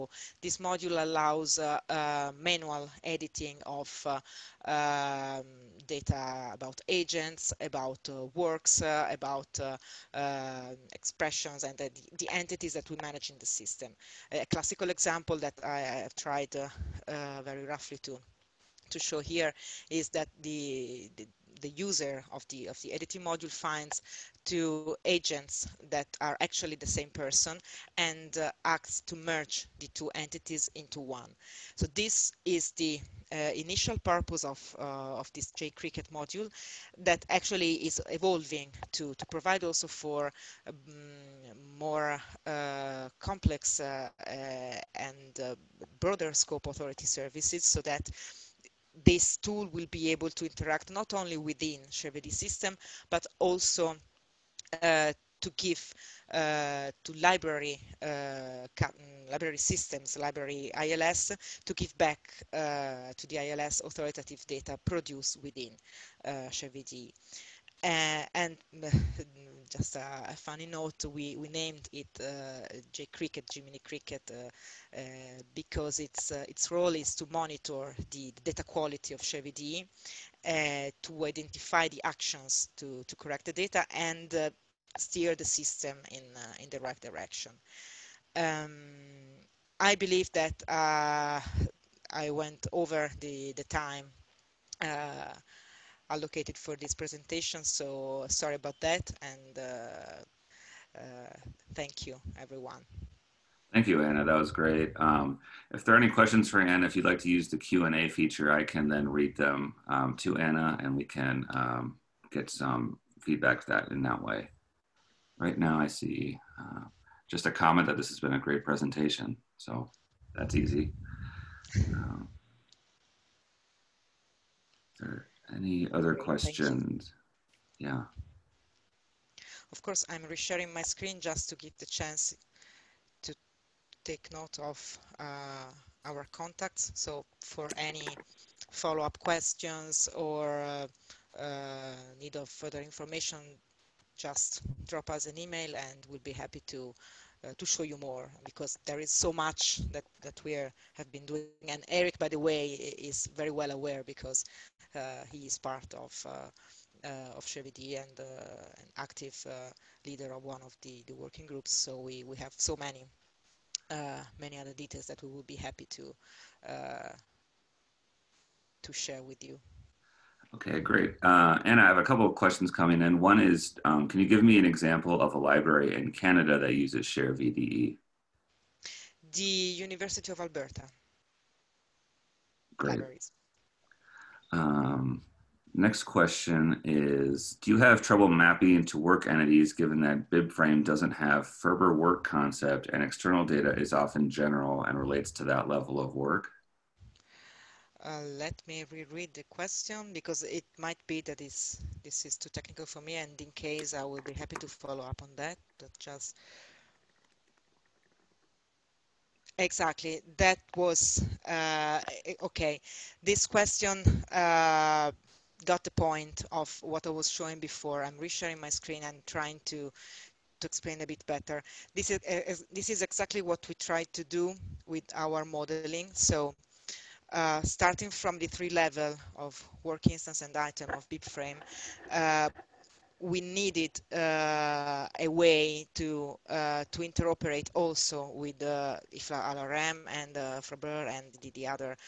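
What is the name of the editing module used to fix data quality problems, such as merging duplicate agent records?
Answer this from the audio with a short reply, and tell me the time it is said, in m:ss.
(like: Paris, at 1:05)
jCricket, at 0:35.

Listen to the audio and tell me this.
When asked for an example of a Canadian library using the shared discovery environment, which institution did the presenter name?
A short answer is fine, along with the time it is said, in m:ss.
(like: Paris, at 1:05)
University of Alberta, at 2:59.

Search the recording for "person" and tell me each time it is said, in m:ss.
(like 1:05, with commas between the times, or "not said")
0:27.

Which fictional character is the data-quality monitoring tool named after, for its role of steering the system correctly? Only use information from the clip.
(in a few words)
Jiminy Cricket.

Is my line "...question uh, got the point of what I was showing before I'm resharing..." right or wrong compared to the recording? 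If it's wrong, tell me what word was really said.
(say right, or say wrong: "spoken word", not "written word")
right.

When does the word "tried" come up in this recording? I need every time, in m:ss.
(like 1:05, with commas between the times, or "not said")
0:16, 3:43.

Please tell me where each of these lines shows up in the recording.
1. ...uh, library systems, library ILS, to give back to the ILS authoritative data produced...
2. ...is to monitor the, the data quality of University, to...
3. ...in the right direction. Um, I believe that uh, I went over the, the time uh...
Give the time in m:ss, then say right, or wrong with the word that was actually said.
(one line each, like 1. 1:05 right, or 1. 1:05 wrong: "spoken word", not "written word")
1. 0:58 right
2. 1:16 wrong: "ShareVDE", not "University"
3. 1:26 right.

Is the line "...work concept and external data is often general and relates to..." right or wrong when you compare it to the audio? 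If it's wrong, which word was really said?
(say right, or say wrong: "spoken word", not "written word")
right.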